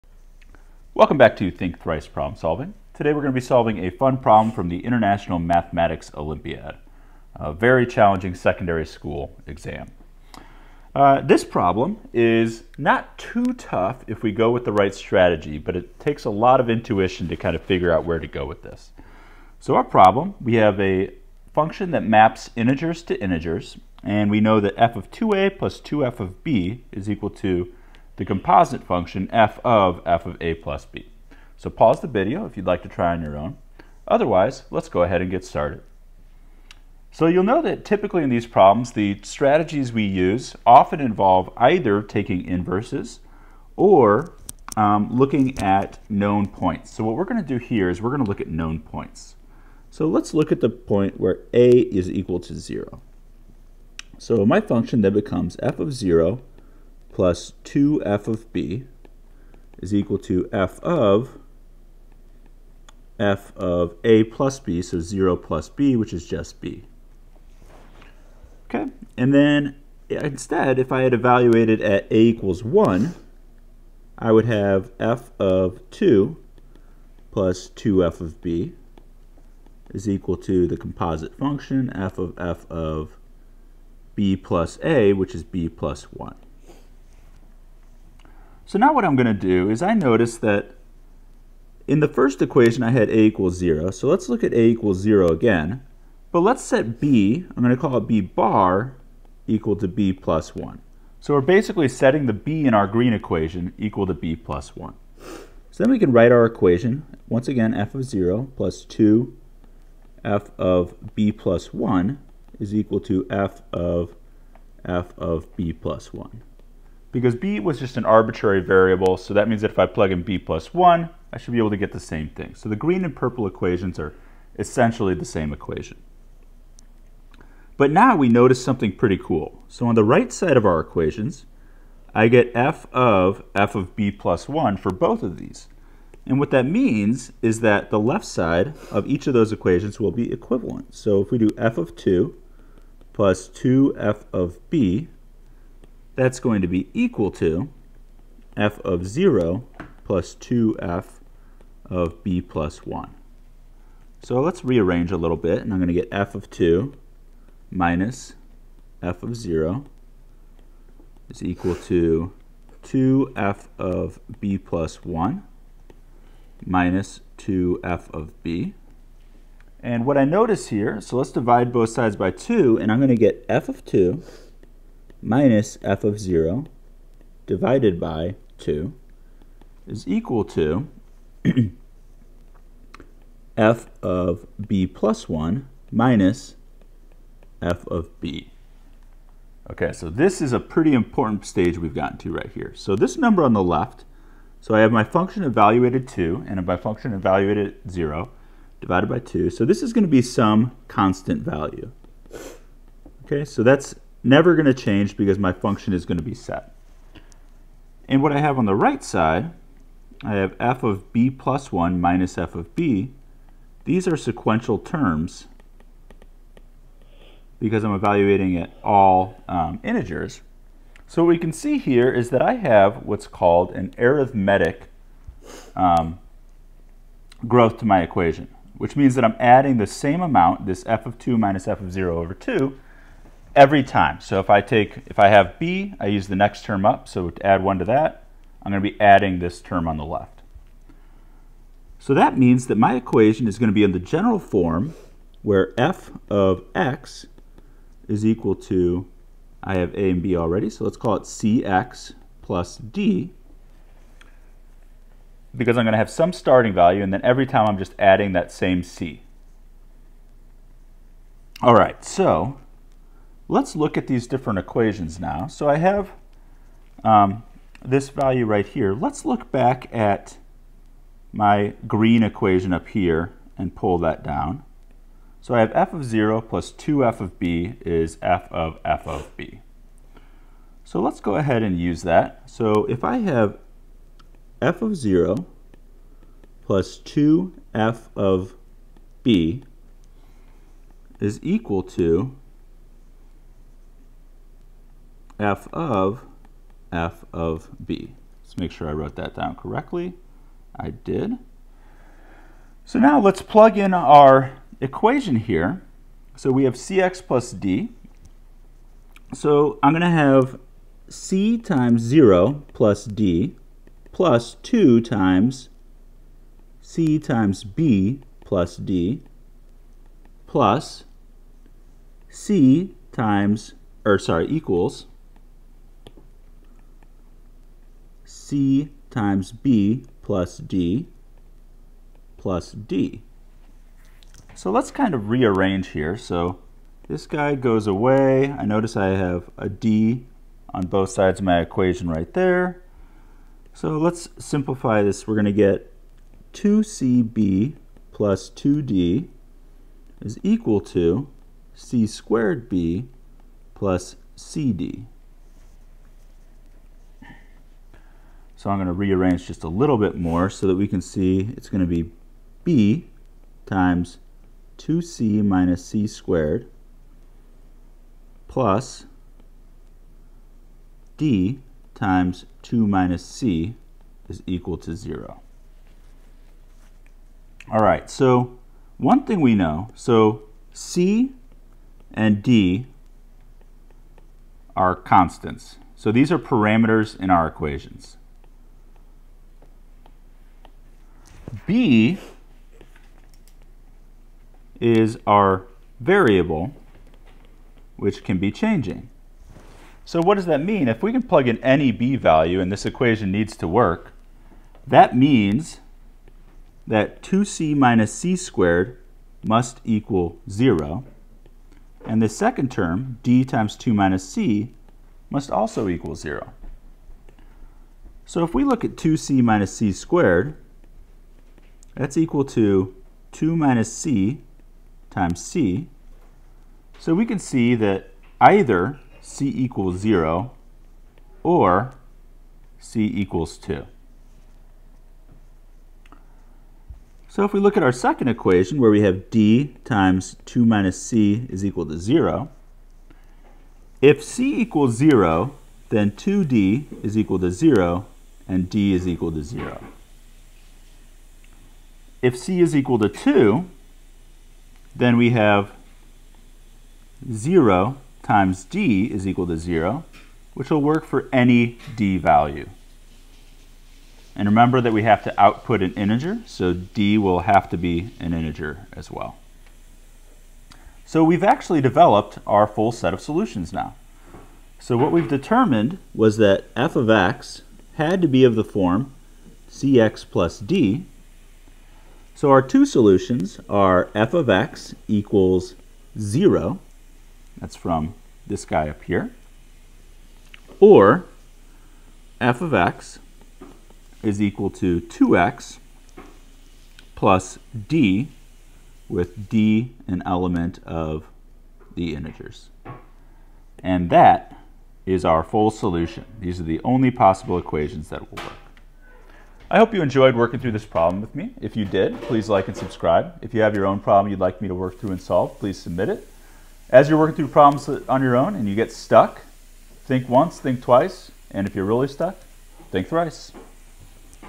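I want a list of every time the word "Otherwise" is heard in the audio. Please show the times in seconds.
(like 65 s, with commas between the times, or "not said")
34 s.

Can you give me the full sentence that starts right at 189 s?
Okay, so this is a pretty important stage we've gotten to right here.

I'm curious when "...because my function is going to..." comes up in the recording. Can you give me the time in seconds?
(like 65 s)
205 s.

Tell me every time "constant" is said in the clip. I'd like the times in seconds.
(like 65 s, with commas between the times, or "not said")
200 s, 384 s.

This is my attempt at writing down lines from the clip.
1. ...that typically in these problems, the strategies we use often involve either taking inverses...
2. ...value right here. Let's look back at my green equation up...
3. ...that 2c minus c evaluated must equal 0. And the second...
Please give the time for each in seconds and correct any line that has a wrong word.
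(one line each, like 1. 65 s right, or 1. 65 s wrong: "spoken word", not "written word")
1. 37 s right
2. 268 s right
3. 406 s wrong: "squared", not "evaluated".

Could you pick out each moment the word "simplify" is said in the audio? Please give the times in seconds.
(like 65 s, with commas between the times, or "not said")
344 s.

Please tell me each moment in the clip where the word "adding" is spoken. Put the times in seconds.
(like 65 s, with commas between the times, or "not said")
229 s, 238 s, 257 s.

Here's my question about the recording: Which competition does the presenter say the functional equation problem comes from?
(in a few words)
International Mathematics Olympiad.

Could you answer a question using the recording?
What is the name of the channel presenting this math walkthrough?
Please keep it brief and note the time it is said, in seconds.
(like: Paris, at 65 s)
Think Thrice Problem Solving, at 1 s.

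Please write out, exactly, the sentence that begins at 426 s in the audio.
So we can see that either c equals 0 or c equals 2.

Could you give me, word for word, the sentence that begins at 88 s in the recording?
So now what I'm going to do is I notice that in the first equation I had a equals 0.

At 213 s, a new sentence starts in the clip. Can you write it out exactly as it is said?
These are sequential terms because I'm evaluating at all um, integers.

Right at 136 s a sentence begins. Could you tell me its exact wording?
And what that means is that the left side of each of those equations will be equivalent.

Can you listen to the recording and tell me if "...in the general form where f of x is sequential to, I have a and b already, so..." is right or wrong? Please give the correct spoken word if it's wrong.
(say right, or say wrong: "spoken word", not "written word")
wrong: "equal", not "sequential".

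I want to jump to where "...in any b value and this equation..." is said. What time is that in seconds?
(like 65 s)
401 s.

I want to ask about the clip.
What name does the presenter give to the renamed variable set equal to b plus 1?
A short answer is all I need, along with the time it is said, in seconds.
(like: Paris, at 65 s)
b bar, at 98 s.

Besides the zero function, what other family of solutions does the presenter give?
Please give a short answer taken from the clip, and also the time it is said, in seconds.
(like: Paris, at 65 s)
f(x) = 2x + d, at 492 s.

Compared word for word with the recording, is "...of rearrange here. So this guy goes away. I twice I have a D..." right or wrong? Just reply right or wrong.
wrong.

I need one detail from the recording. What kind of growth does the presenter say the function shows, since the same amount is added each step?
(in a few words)
arithmetic.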